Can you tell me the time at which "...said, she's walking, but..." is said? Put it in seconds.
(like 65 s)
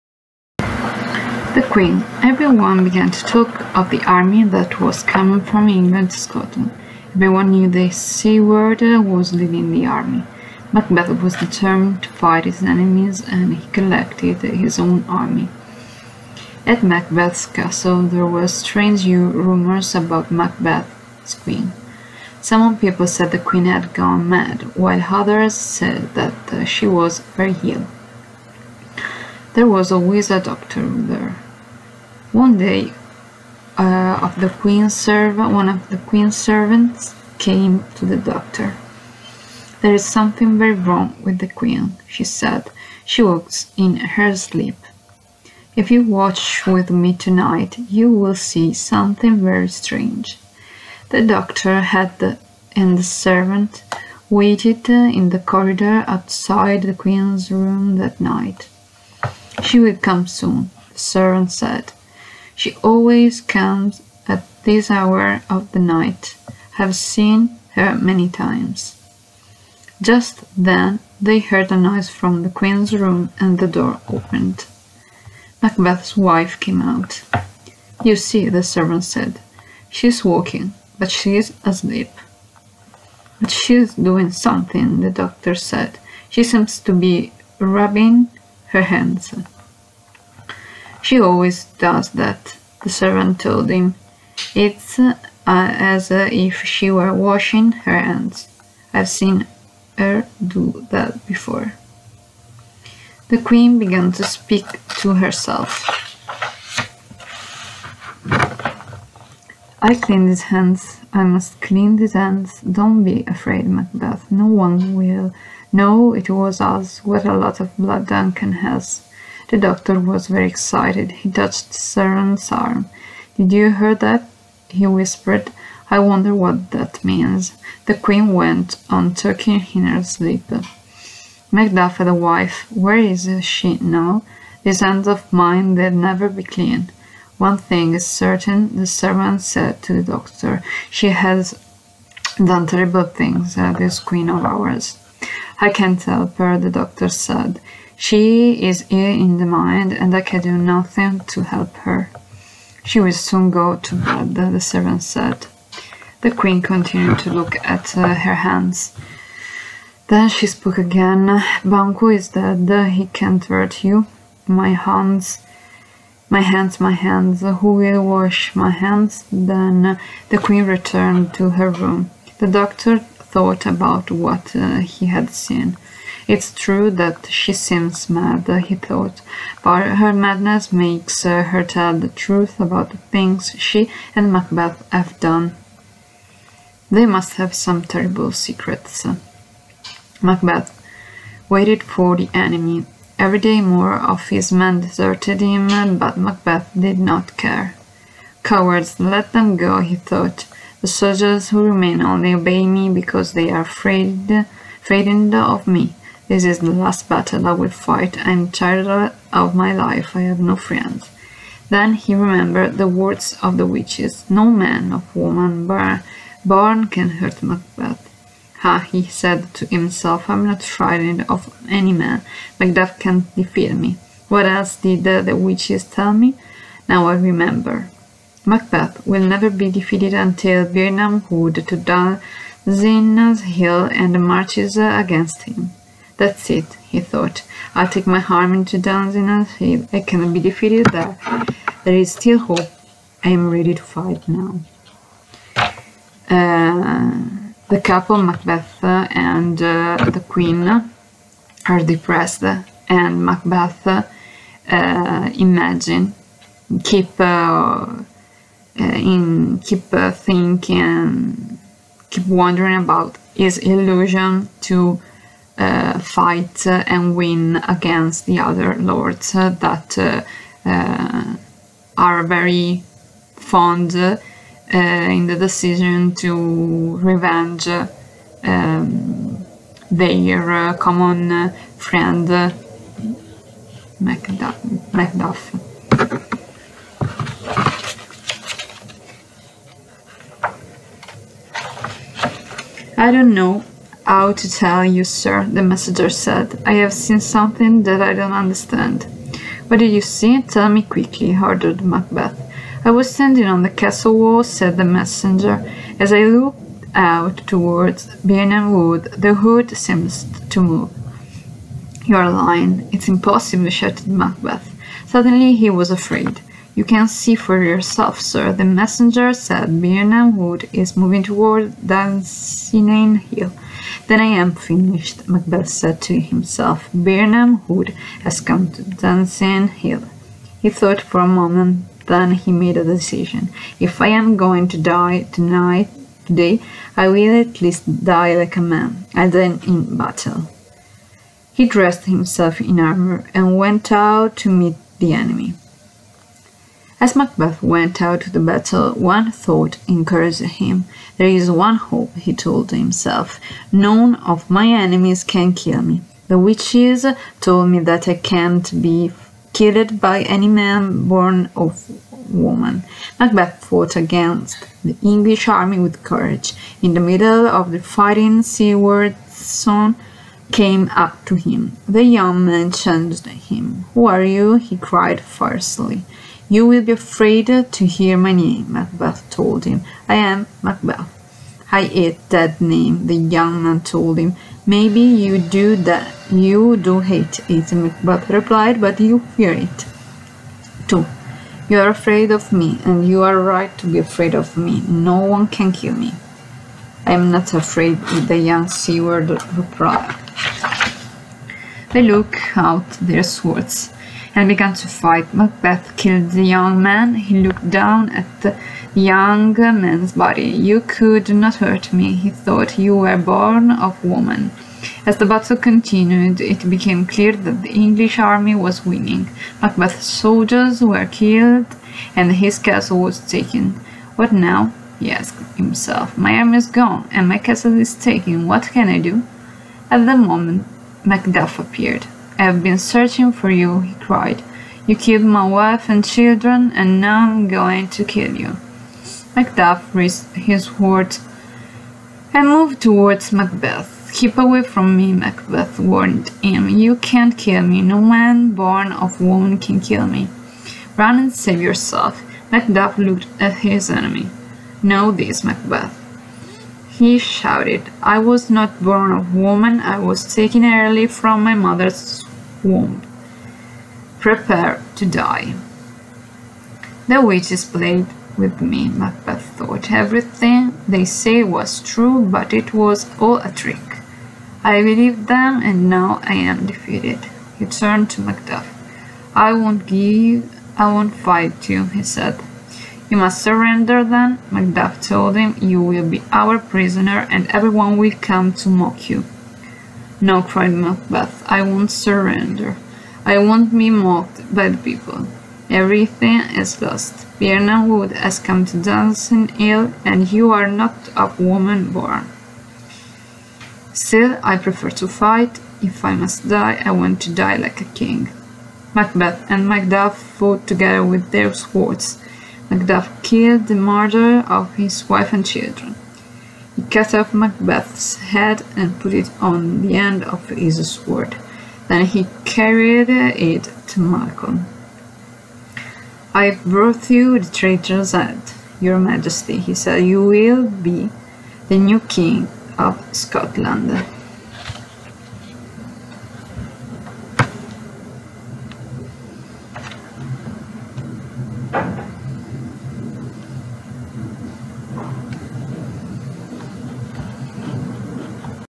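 79 s.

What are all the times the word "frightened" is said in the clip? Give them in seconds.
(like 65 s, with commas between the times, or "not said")
204 s, 220 s.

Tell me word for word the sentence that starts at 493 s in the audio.
I won't be mocked by the people.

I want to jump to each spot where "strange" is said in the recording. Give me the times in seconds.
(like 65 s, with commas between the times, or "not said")
18 s, 49 s.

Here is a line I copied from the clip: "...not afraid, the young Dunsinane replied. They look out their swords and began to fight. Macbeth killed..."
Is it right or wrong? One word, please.
wrong.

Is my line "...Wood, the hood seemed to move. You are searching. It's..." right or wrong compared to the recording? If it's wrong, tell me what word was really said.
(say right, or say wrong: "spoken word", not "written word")
wrong: "lying", not "searching".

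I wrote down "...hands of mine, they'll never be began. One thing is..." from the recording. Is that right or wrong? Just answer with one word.
wrong.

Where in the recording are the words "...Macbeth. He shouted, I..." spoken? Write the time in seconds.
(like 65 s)
455 s.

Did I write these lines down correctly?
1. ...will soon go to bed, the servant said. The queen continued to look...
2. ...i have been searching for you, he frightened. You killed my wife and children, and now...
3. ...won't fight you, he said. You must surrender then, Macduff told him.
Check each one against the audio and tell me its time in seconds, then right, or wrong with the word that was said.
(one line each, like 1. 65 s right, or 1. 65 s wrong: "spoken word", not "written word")
1. 152 s right
2. 432 s wrong: "cried", not "frightened"
3. 480 s right.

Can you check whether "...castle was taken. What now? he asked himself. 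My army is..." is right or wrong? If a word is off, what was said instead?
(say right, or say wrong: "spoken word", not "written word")
right.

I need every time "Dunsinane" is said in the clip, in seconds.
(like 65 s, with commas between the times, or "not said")
231 s, 238 s, 321 s, 328 s, 498 s.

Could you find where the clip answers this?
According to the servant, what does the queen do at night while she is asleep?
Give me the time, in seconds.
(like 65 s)
43 s.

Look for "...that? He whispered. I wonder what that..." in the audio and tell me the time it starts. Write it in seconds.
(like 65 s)
123 s.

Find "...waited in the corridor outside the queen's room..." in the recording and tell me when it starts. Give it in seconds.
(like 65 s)
54 s.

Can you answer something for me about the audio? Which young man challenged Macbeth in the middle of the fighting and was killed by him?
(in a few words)
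Young Seward.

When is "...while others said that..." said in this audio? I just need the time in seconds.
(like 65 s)
24 s.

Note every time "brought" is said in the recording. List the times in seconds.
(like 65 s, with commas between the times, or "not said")
526 s.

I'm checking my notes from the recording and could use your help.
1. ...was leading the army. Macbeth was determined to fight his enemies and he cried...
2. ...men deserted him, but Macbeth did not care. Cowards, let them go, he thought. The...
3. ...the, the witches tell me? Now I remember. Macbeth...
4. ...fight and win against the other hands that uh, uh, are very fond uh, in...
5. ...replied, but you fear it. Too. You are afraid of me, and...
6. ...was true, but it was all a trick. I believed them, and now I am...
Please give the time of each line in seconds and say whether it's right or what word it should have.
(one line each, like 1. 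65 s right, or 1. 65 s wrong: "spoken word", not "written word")
1. 8 s wrong: "collected", not "cried"
2. 194 s right
3. 225 s right
4. 265 s wrong: "lords", not "hands"
5. 388 s right
6. 471 s right.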